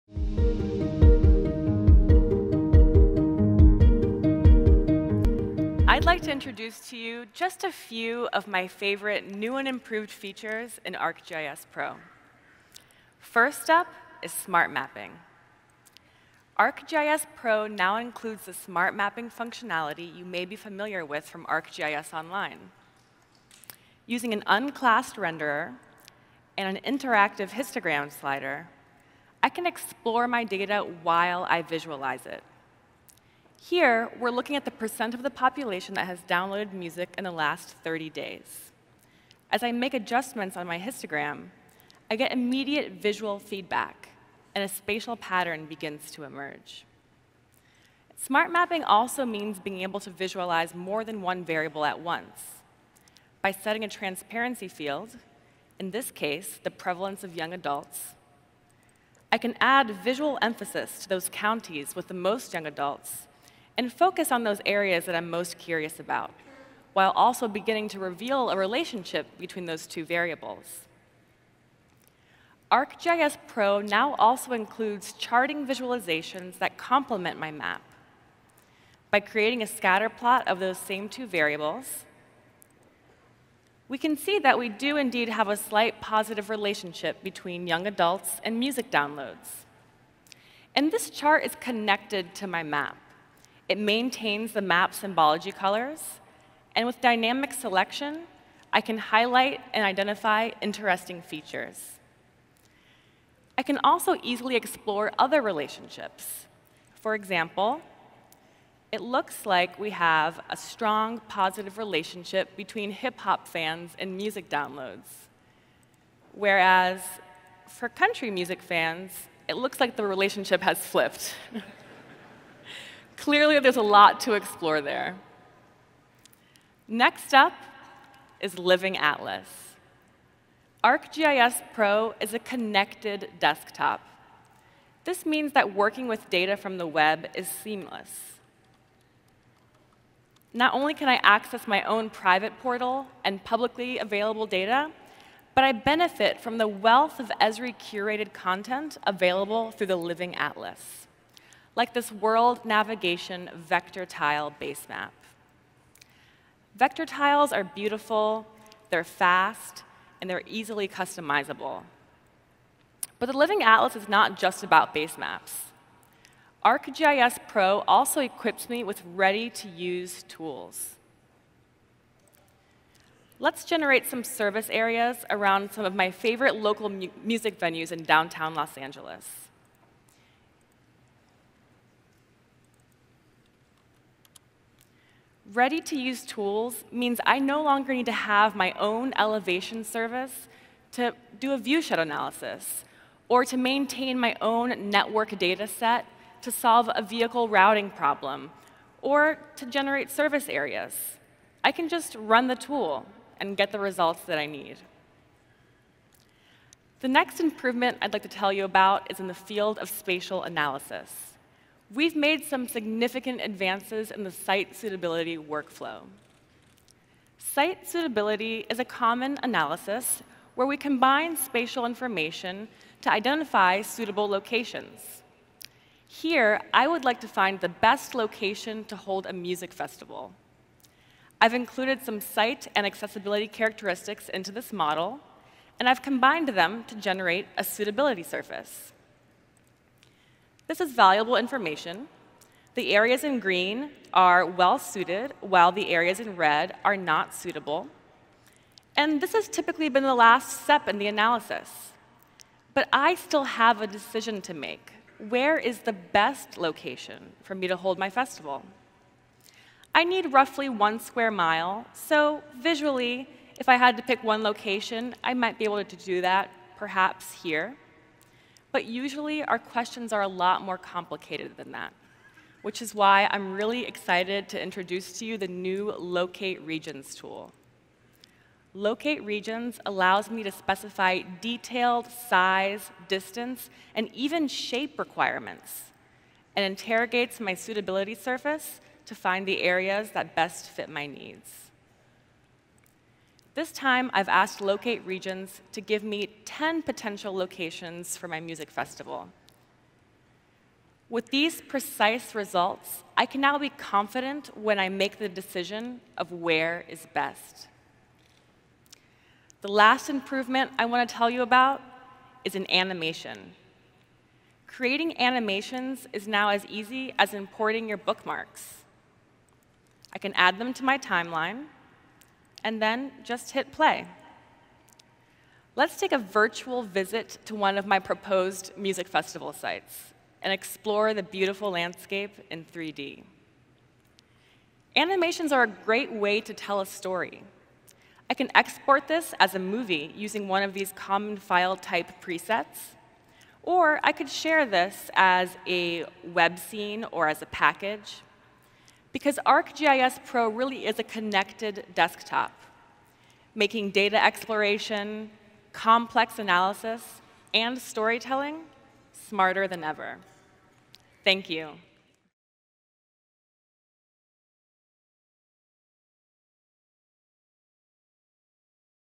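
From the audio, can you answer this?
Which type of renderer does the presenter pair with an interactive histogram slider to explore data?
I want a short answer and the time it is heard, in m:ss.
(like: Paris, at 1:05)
unclassed, at 0:24.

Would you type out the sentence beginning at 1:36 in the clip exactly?
And with dynamic selection, I can highlight and identify interesting features.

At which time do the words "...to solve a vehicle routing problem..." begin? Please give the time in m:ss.
3:16.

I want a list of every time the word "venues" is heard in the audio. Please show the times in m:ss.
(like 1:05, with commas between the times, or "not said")
2:57.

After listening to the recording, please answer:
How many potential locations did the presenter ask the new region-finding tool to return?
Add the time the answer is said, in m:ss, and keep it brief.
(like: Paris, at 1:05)
10, at 4:56.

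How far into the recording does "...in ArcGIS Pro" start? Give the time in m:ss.
0:10.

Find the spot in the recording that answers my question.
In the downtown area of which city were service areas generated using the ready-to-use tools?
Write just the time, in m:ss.
2:58.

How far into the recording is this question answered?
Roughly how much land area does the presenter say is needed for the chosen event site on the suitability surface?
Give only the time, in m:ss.
4:20.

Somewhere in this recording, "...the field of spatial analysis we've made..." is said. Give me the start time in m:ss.
3:29.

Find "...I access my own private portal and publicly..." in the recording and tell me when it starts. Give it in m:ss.
2:21.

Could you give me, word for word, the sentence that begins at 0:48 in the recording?
Smart mapping also means being able to visualize more than one variable at once.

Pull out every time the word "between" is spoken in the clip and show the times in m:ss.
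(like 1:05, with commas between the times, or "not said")
1:09, 1:27, 1:52.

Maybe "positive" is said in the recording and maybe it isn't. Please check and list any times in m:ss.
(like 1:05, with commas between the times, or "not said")
1:25, 1:51.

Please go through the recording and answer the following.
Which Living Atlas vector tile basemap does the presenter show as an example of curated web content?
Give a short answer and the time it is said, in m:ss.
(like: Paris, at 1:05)
world navigation, at 2:32.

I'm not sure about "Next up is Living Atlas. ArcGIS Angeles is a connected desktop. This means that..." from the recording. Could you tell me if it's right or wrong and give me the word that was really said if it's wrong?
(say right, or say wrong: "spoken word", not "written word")
wrong: "Pro", not "Angeles".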